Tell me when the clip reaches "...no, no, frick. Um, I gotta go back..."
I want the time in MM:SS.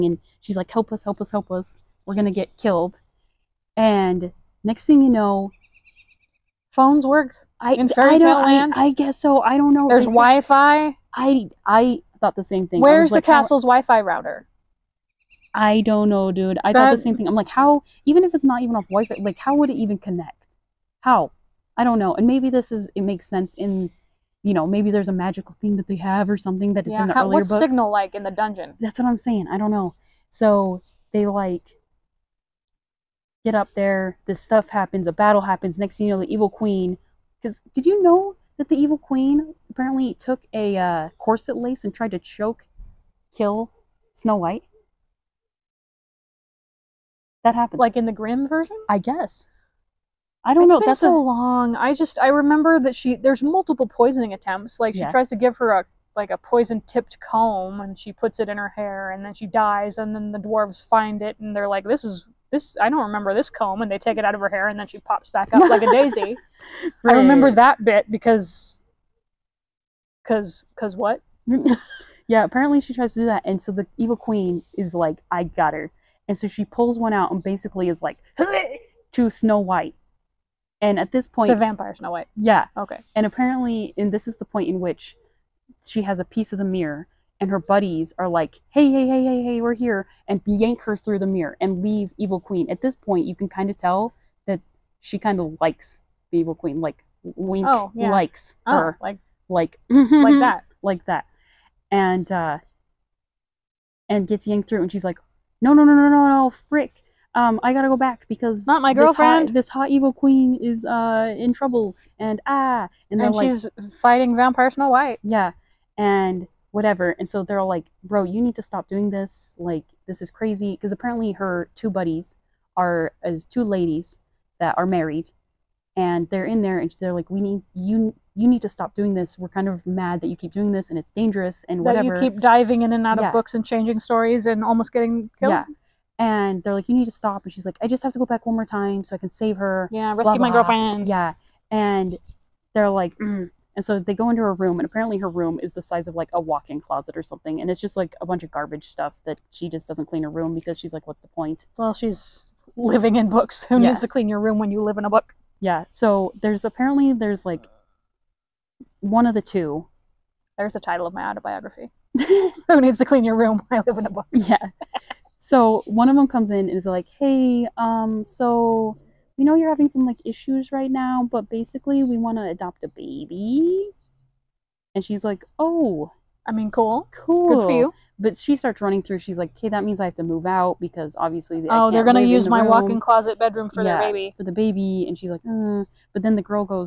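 01:46.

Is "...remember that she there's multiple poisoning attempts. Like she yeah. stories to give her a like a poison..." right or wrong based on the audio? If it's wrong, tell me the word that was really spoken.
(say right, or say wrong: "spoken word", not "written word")
wrong: "tries", not "stories".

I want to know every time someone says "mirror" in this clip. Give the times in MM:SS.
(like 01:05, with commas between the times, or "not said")
01:26, 01:31.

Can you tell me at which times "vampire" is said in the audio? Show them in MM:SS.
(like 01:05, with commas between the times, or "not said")
01:21, 01:54.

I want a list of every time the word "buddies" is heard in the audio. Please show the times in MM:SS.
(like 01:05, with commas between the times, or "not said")
01:27, 02:01.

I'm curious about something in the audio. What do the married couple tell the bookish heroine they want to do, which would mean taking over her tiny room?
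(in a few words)
adopt a baby.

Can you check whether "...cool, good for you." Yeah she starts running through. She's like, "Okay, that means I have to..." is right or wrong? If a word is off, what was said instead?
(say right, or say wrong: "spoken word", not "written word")
wrong: "But", not "Yeah".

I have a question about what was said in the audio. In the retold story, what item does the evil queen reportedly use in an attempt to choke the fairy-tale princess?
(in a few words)
corset lace.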